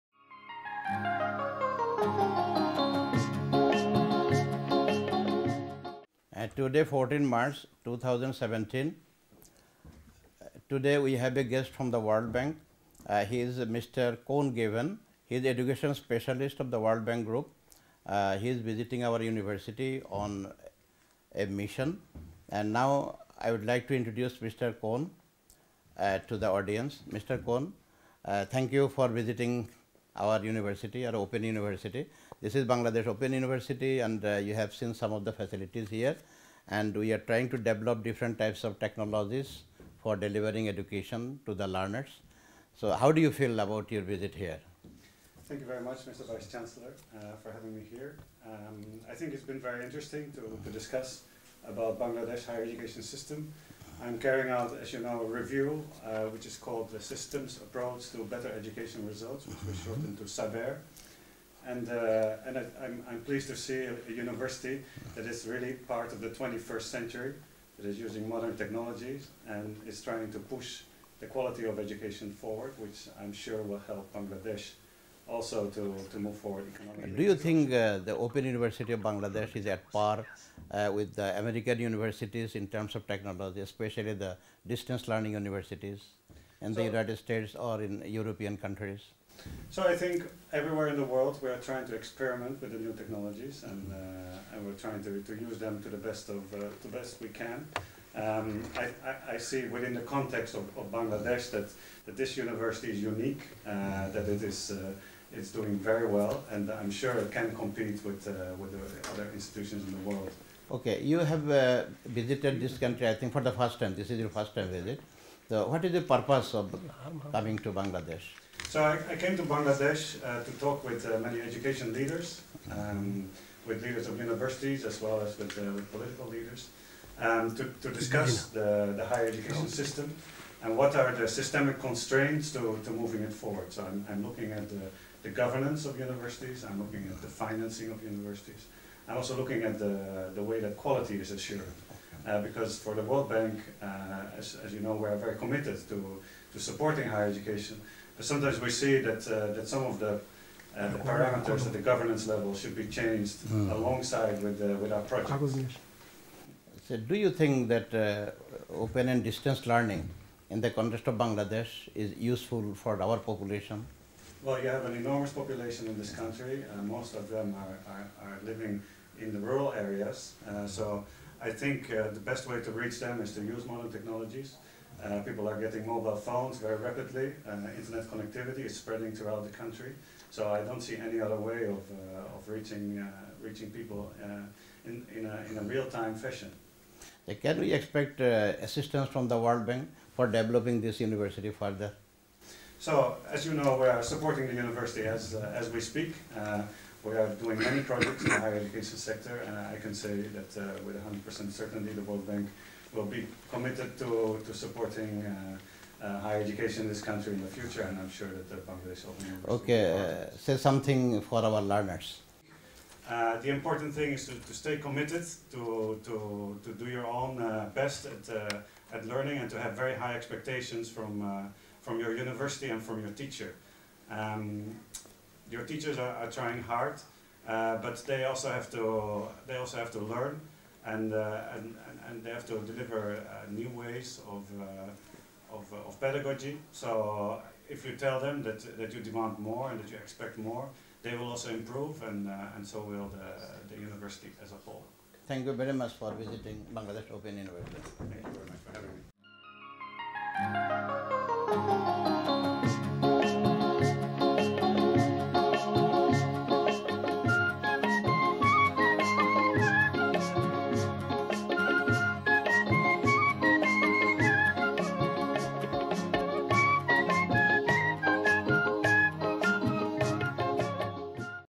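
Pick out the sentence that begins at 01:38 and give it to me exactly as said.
Um, I, I, I, see within the context of, of, Bangladesh that, that this university is unique, uh, mm-hmm.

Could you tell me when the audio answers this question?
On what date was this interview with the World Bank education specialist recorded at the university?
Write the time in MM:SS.
00:06.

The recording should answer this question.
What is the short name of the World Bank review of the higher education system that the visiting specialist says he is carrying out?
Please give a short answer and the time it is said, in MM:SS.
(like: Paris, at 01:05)
SABER, at 01:00.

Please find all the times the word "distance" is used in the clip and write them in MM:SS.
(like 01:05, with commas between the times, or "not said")
01:24, 02:39.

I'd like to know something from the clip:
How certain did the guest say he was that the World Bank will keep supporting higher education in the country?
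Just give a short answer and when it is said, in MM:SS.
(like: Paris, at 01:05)
100% certainty, at 03:20.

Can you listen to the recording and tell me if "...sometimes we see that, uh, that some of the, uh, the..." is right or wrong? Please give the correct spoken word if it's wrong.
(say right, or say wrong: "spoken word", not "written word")
right.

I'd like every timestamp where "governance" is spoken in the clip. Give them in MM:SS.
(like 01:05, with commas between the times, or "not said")
02:15, 02:31.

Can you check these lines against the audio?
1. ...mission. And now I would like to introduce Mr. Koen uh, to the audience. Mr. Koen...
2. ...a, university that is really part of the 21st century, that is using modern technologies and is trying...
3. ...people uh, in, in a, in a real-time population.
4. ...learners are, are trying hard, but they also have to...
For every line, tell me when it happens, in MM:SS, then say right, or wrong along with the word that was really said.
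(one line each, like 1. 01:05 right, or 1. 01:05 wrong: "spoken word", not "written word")
1. 00:21 right
2. 01:04 right
3. 03:03 wrong: "fashion", not "population"
4. 03:45 wrong: "teachers", not "learners".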